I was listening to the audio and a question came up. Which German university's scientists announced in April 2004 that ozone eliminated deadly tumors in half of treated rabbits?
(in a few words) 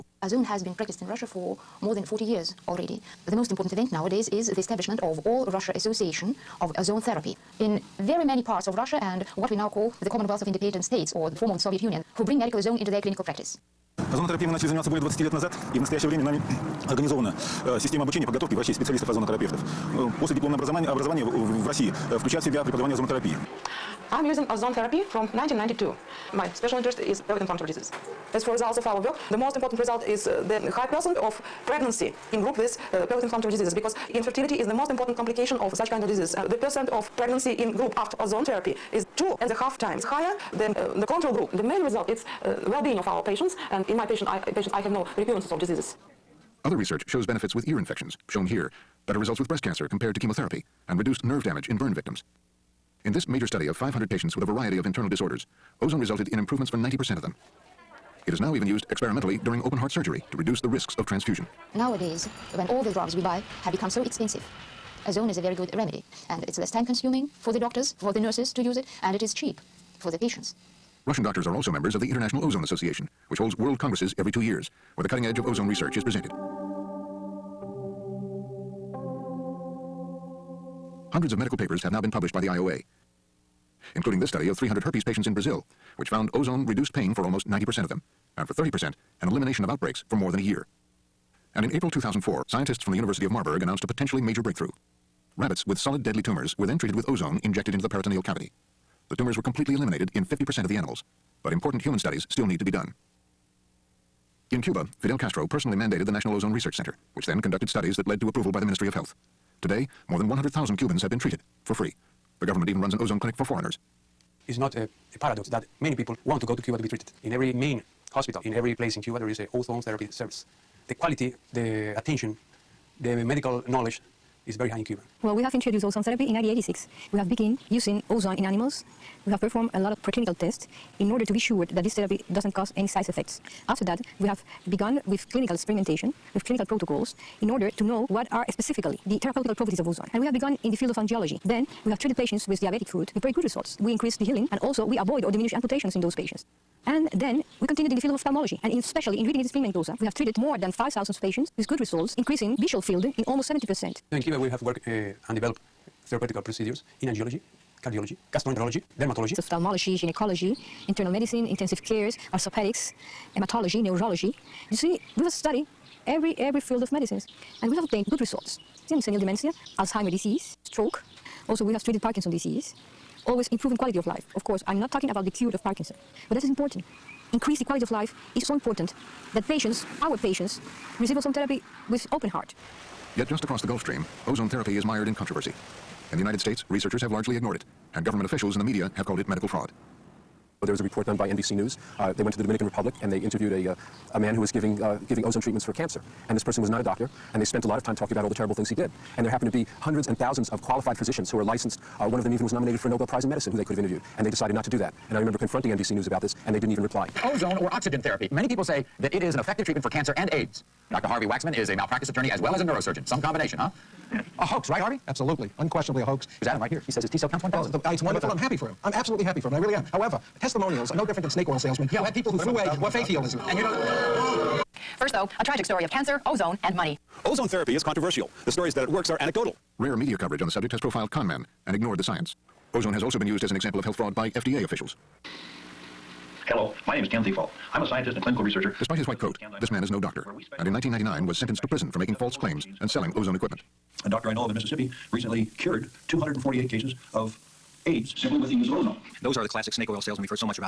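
University of Marburg.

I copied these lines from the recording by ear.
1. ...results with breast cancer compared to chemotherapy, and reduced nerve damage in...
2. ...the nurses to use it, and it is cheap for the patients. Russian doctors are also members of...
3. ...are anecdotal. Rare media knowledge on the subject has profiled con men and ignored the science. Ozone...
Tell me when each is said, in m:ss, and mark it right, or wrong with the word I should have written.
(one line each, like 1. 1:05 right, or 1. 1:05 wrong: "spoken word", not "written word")
1. 0:49 right
2. 1:08 right
3. 3:49 wrong: "coverage", not "knowledge".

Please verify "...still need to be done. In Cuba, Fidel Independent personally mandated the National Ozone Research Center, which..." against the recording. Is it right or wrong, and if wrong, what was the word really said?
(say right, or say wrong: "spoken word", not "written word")
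wrong: "Castro", not "Independent".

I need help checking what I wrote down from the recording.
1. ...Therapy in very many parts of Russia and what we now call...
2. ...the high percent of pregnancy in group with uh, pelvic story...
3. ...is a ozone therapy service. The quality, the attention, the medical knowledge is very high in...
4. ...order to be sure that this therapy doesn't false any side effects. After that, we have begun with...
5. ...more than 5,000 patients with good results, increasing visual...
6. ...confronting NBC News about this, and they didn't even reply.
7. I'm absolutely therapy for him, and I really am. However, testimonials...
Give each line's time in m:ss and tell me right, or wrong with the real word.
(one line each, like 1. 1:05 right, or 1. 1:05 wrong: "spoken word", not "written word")
1. 0:07 right
2. 0:30 wrong: "inflammatory", not "story"
3. 1:59 right
4. 2:11 wrong: "cause", not "false"
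5. 2:30 right
6. 3:25 right
7. 3:38 wrong: "happy", not "therapy".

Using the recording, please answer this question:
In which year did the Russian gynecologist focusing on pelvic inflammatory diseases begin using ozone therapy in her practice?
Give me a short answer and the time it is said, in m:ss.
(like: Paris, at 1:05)
1992, at 0:25.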